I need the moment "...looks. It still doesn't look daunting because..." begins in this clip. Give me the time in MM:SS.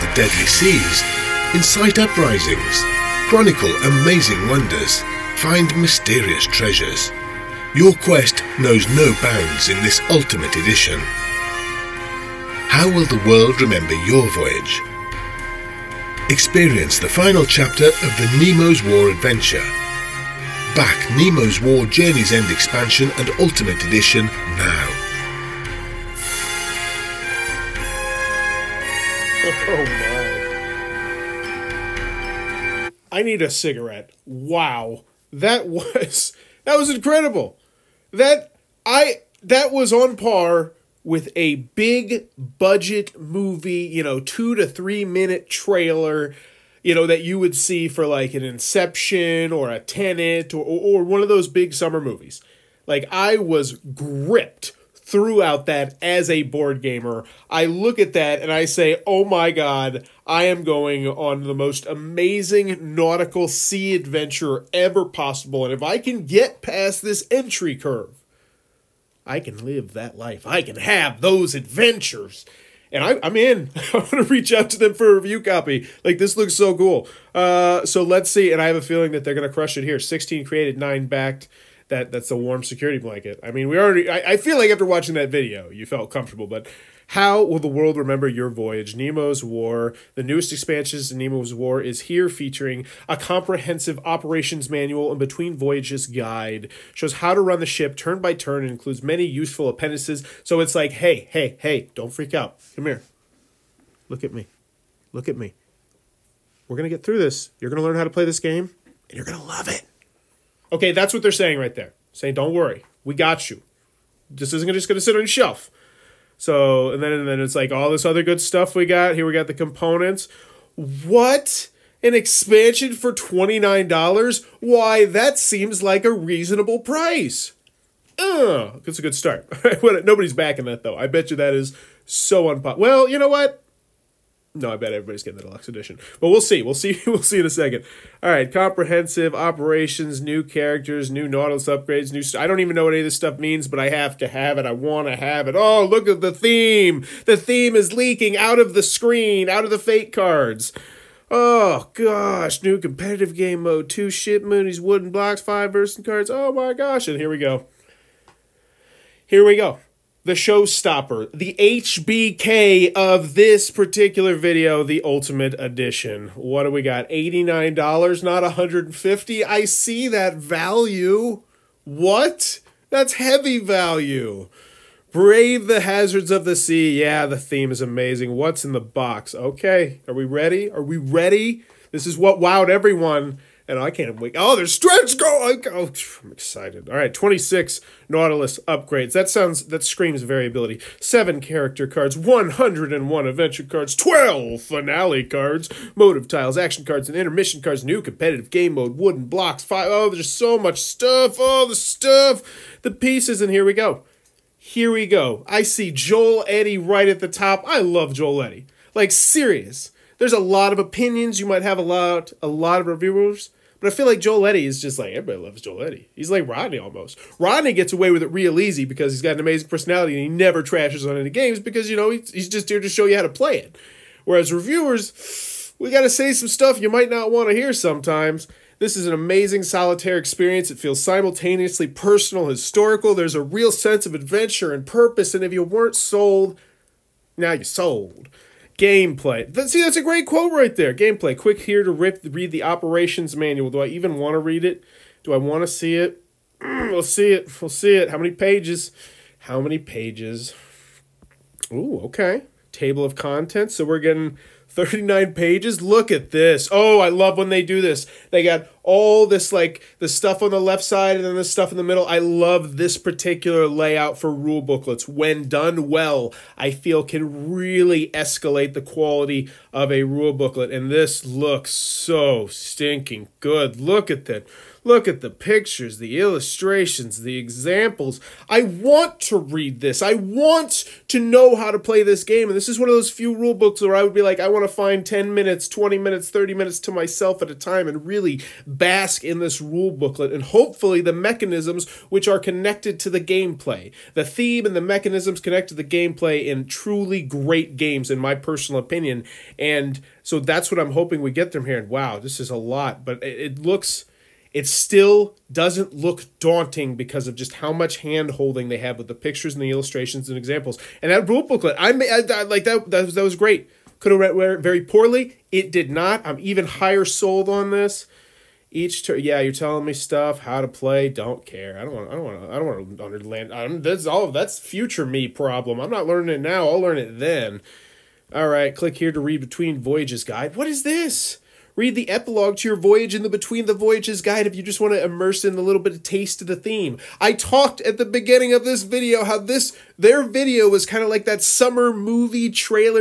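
05:03.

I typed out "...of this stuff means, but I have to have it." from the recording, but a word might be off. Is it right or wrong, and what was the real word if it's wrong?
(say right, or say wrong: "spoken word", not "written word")
right.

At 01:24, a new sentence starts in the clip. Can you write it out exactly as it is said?
I, I feel like after watching that video, you felt comfortable, but how will the world remember your voyage?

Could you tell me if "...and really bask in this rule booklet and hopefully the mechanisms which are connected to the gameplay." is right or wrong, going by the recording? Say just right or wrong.
right.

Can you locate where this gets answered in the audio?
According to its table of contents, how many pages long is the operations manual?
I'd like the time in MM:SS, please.
04:14.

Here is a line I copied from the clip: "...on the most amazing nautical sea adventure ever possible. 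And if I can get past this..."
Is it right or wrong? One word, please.
right.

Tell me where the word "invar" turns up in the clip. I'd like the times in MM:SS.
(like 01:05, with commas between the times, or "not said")
not said.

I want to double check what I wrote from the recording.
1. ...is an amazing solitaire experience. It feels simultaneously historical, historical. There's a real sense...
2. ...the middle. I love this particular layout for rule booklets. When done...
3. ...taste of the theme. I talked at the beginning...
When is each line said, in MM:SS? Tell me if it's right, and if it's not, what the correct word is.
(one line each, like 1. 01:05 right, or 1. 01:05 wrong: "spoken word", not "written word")
1. 03:48 wrong: "personal", not "historical"
2. 04:21 right
3. 05:36 right.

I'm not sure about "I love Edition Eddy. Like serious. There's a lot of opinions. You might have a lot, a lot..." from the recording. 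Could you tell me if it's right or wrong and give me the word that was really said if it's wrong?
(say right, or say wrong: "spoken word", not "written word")
wrong: "Joel", not "Edition".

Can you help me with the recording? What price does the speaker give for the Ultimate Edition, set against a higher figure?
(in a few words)
$89.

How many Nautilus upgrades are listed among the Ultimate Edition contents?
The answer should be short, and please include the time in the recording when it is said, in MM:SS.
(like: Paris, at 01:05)
26, at 03:07.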